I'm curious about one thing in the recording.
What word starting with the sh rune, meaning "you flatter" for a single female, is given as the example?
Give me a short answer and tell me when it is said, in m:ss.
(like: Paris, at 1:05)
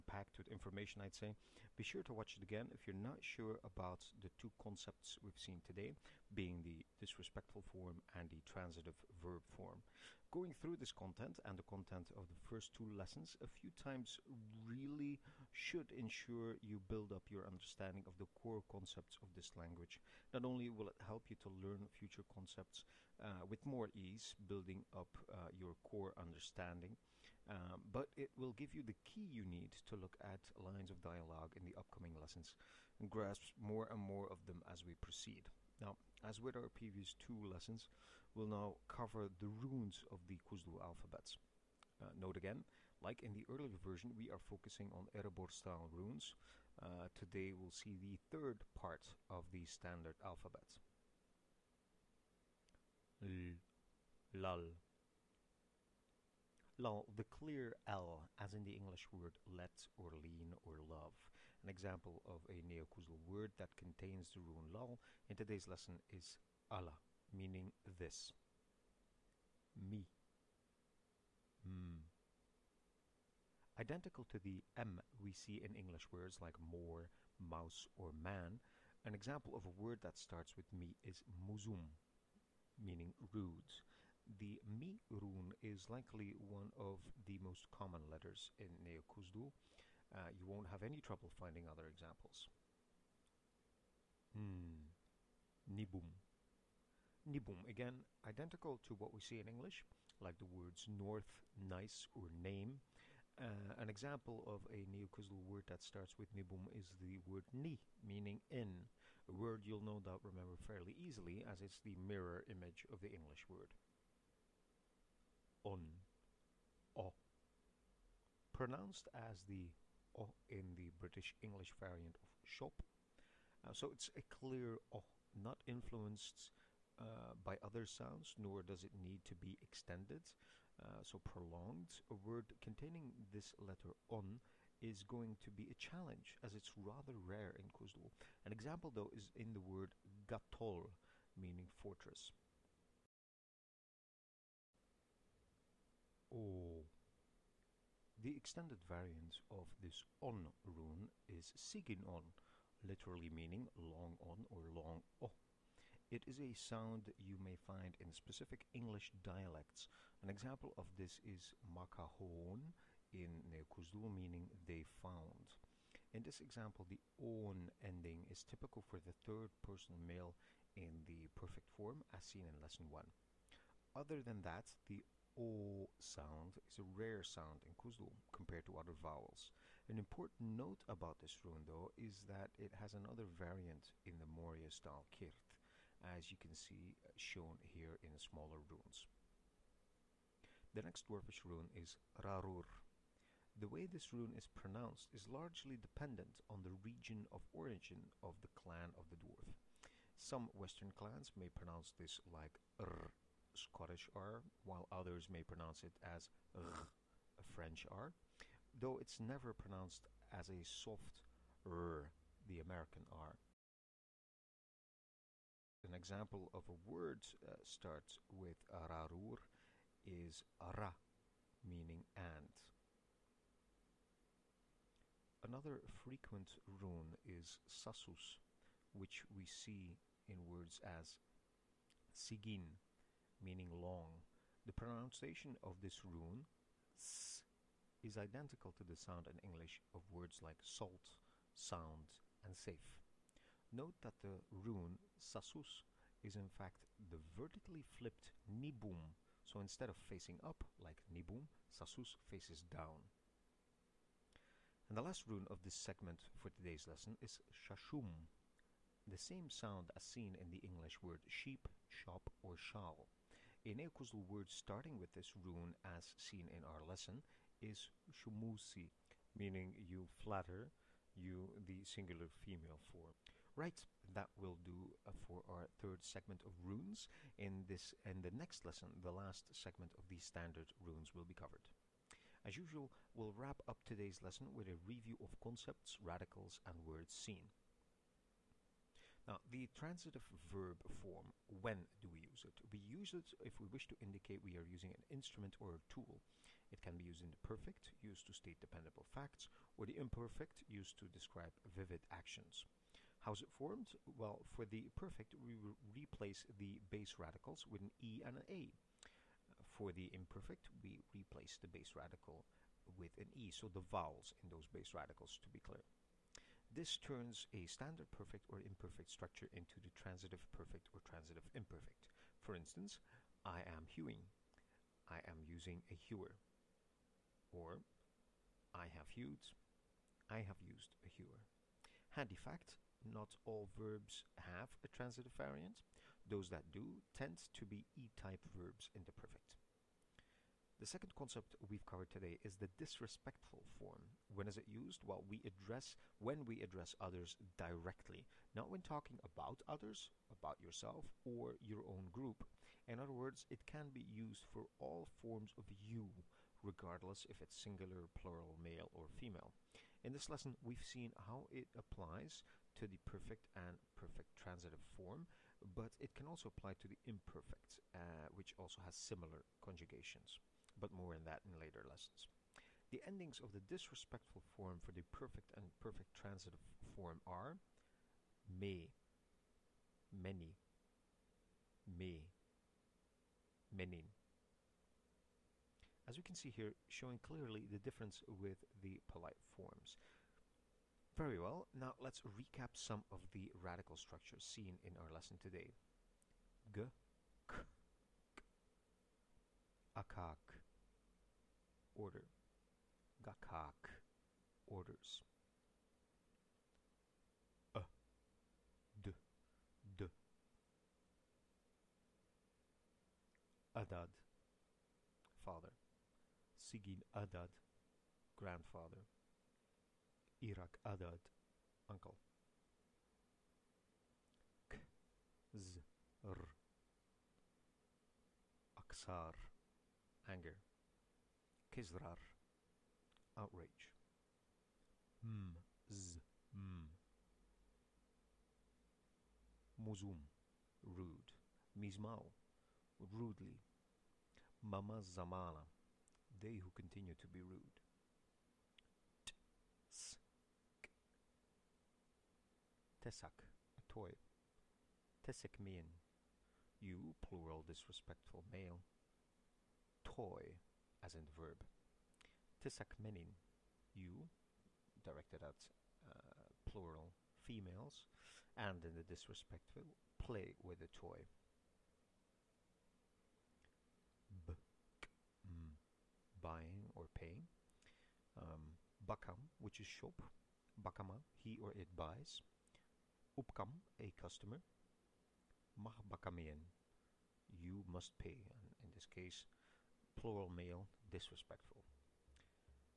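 shumusi, at 4:28.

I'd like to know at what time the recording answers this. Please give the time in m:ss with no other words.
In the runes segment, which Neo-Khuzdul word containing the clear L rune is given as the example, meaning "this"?
1:06.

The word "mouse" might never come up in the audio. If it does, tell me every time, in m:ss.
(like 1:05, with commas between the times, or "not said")
1:17.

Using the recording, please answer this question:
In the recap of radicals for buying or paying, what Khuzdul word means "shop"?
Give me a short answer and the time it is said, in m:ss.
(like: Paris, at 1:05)
bakam, at 7:59.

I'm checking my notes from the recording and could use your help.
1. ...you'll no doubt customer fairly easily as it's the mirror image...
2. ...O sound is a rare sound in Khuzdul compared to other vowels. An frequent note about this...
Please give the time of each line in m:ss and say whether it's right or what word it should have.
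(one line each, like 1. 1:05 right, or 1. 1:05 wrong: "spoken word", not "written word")
1. 1:49 wrong: "remember", not "customer"
2. 2:55 wrong: "important", not "frequent".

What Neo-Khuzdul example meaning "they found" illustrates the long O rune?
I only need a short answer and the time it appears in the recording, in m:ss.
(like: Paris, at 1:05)
makahon, at 2:41.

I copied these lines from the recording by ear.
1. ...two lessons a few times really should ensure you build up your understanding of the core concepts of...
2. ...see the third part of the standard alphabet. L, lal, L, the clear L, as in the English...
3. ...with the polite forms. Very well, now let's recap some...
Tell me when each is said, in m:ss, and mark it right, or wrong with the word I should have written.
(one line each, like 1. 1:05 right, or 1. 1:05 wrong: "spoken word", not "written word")
1. 0:12 right
2. 0:47 right
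3. 6:28 right.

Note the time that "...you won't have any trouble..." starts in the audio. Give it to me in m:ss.
1:30.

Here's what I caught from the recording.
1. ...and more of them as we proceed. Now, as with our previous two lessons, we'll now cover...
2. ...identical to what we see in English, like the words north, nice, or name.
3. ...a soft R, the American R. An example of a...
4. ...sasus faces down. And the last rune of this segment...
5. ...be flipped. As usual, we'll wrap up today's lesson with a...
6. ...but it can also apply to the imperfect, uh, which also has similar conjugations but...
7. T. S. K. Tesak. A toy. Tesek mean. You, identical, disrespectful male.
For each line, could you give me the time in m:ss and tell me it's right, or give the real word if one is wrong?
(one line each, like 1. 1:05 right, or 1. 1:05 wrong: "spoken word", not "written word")
1. 0:33 right
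2. 1:38 right
3. 3:30 right
4. 4:11 right
5. 4:41 wrong: "covered", not "flipped"
6. 6:05 right
7. 7:29 wrong: "plural", not "identical".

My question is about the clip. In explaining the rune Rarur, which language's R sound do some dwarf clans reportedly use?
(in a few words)
French.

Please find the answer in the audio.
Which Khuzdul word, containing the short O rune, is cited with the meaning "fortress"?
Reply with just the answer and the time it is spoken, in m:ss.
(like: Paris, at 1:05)
gatol, at 2:20.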